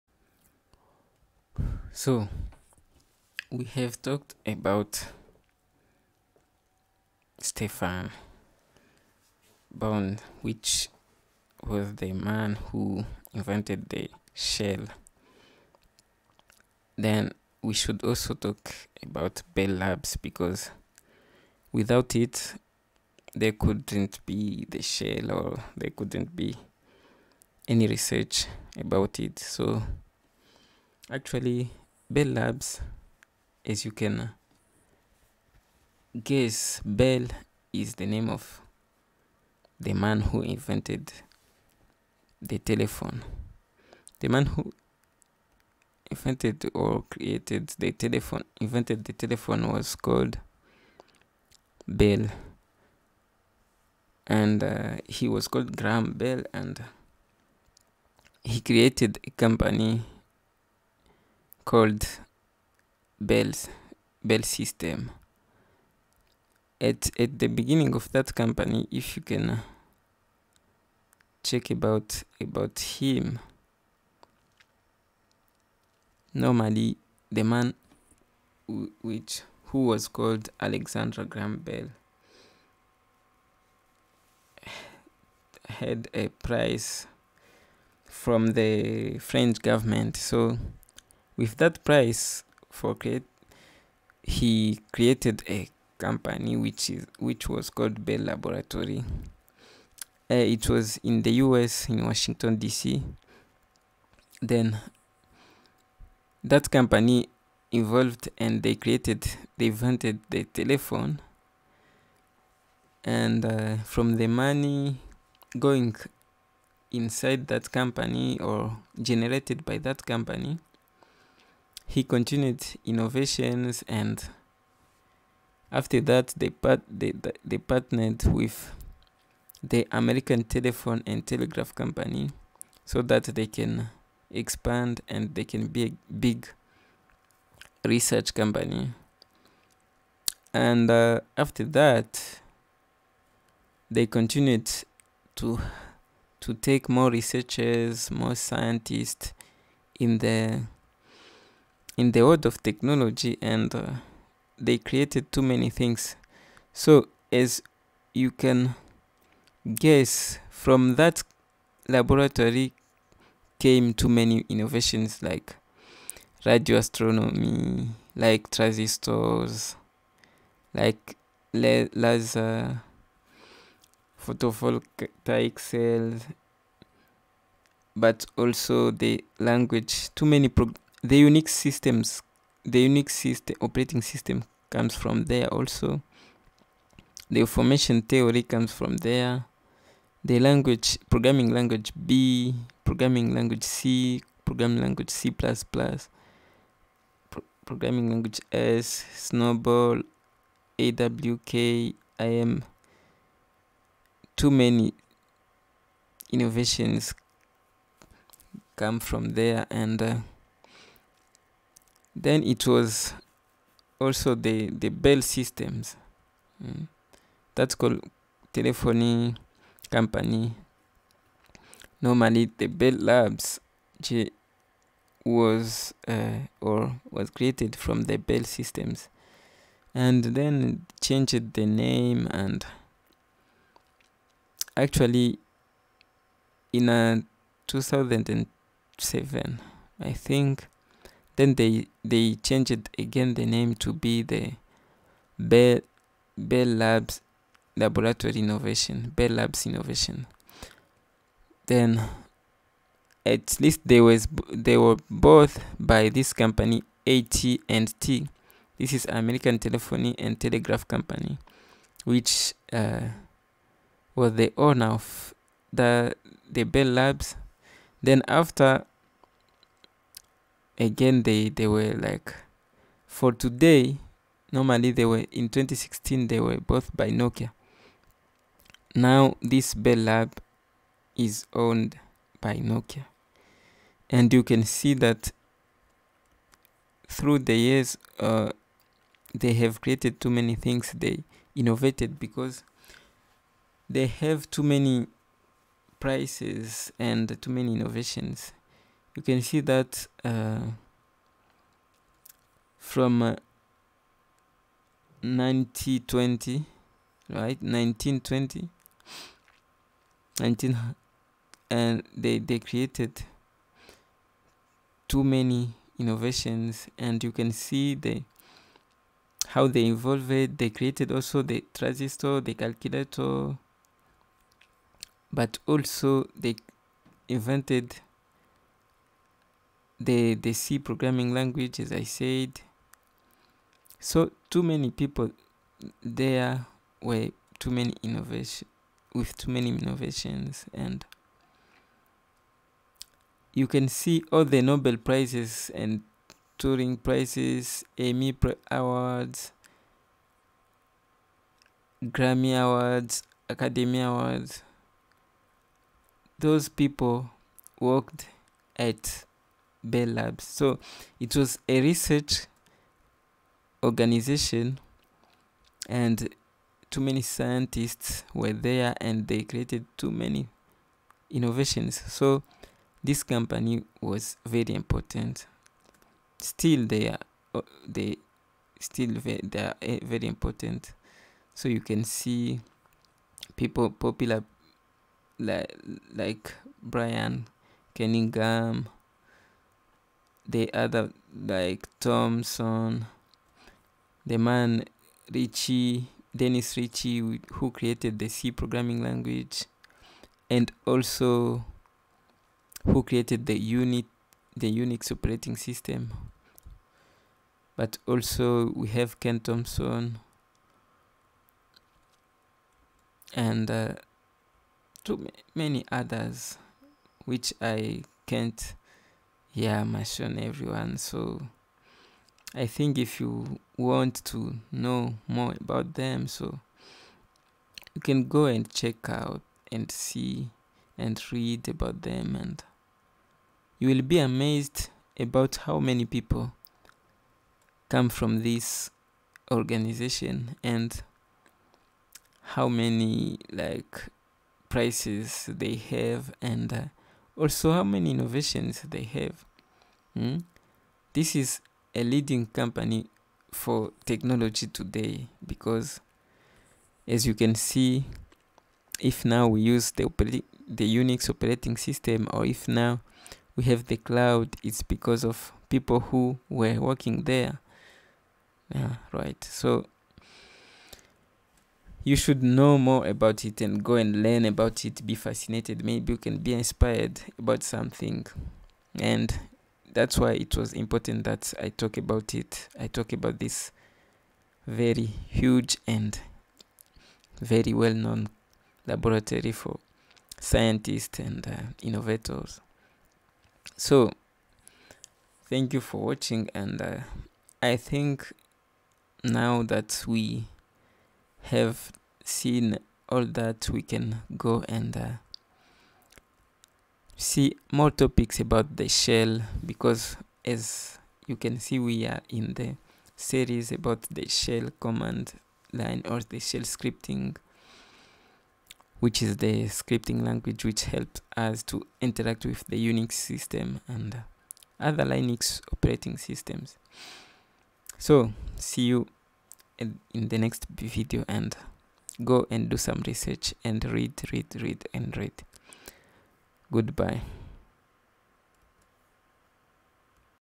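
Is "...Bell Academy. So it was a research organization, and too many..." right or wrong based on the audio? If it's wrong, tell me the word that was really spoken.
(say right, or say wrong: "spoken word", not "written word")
wrong: "Labs", not "Academy".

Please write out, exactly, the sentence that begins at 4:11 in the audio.
Then at least they was they were both by this company AT&T.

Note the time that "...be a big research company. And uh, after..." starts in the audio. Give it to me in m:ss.
2:15.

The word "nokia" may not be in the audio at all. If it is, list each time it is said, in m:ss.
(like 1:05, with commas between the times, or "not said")
4:37, 4:42.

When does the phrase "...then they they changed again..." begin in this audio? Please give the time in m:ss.
4:01.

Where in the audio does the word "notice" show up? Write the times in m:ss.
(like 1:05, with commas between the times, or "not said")
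not said.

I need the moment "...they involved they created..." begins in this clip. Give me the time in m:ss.
5:19.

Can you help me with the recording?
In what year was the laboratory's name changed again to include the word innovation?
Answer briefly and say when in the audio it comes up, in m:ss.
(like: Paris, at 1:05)
2007, at 3:57.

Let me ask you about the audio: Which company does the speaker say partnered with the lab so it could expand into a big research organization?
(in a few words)
American Telephone and Telegraph Company.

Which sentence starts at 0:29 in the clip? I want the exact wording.
So, actually, Bell Labs, as you can uh, guess, Bell is the name of the man who invented the telephone.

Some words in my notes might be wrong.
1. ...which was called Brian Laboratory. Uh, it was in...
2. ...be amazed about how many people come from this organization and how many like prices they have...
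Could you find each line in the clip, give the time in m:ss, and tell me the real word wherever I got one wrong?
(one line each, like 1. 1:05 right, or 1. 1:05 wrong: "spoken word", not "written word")
1. 1:37 wrong: "Bell", not "Brian"
2. 7:14 right.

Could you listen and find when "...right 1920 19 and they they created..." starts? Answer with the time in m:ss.
5:07.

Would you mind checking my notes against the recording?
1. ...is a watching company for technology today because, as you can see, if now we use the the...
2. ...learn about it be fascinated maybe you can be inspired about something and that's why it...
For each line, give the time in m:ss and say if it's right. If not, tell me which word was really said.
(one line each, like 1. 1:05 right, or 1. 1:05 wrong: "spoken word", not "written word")
1. 7:31 wrong: "leading", not "watching"
2. 7:54 right.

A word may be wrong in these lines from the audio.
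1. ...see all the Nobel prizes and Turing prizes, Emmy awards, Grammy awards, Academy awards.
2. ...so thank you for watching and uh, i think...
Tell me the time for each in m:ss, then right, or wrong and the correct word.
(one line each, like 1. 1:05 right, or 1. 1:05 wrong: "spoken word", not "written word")
1. 5:43 right
2. 8:13 right.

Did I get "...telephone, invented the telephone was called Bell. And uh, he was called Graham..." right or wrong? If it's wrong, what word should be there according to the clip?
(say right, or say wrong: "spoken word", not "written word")
right.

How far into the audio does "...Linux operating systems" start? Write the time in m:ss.
8:45.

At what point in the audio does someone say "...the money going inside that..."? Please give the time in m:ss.
1:54.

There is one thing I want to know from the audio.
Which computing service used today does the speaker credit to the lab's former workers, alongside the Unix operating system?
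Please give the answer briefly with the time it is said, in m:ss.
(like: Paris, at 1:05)
The cloud, at 7:43.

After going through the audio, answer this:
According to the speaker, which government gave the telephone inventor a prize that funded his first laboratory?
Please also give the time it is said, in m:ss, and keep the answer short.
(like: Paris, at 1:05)
French government, at 1:29.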